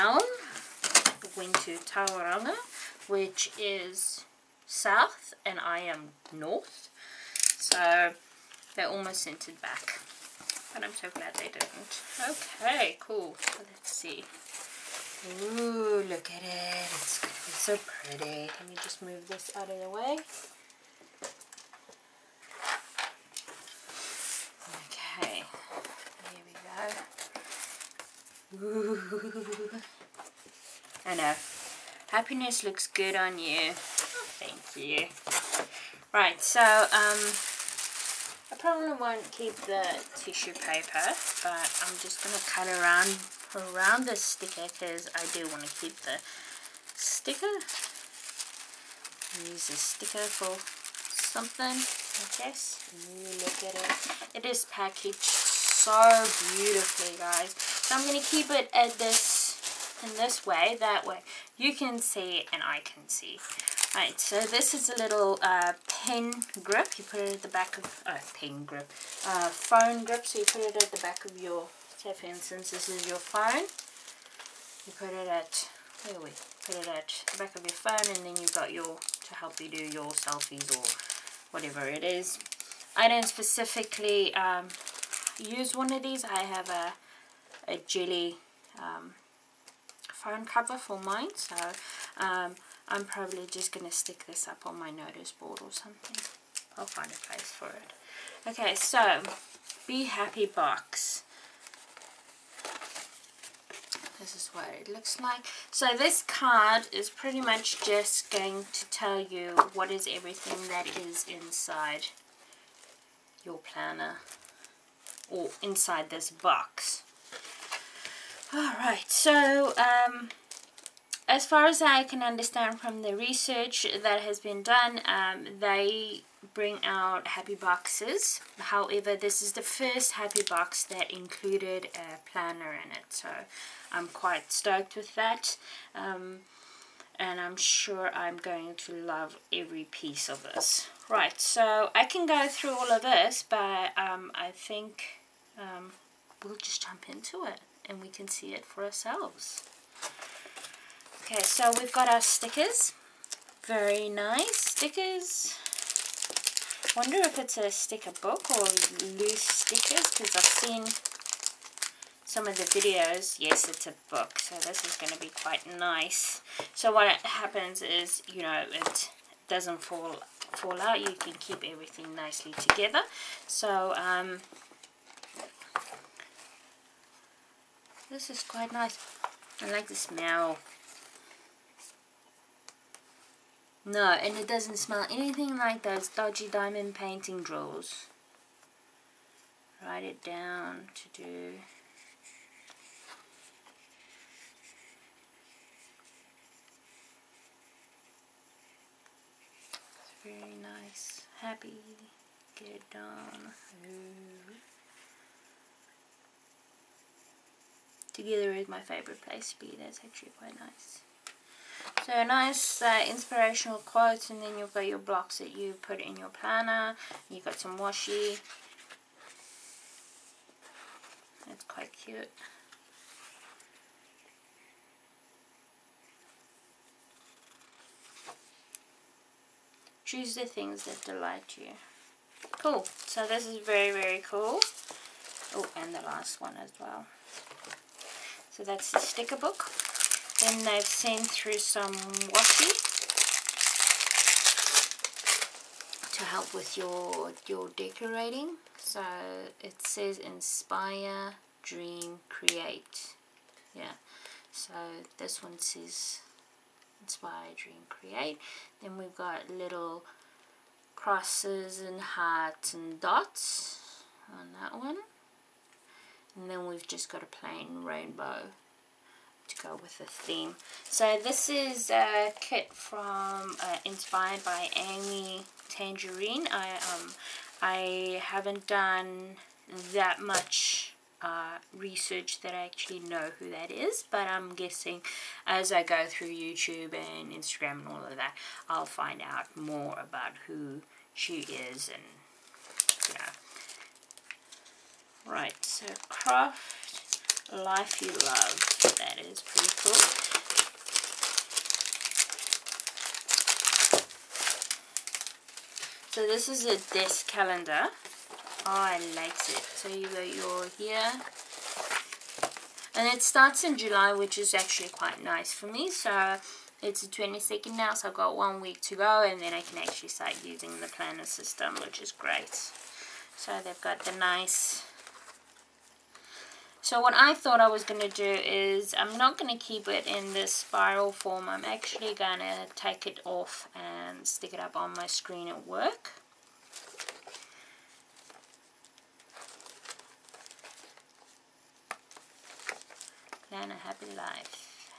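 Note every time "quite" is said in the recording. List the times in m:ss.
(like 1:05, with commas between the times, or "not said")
2:14, 2:45, 2:58, 3:30, 3:41, 5:14.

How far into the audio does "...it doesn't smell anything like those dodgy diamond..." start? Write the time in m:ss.
3:04.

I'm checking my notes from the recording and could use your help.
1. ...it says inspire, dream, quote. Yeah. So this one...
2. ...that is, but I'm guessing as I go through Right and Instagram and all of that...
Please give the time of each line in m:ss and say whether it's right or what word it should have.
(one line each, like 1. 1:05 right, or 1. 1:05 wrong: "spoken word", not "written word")
1. 4:09 wrong: "create", not "quote"
2. 4:43 wrong: "YouTube", not "Right".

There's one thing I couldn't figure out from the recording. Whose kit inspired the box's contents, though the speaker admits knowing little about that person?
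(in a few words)
Amy Tangerine.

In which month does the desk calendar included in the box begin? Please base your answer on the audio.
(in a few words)
July.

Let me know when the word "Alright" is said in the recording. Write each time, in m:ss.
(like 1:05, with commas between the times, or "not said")
1:03, 1:58.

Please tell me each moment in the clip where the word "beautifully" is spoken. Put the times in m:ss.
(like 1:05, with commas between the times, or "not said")
0:56.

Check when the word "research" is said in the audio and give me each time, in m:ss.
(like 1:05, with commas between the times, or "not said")
2:03, 4:41.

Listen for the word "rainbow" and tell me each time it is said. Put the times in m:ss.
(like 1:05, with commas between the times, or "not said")
4:27.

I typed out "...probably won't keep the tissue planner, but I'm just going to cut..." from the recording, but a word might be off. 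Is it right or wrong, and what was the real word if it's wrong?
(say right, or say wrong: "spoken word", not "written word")
wrong: "paper", not "planner".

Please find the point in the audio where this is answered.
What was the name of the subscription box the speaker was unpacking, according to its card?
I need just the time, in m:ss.
1:39.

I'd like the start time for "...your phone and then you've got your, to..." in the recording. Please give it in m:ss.
1:17.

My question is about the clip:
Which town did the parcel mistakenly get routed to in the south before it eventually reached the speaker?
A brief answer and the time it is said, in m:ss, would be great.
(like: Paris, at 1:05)
Tauranga, at 0:01.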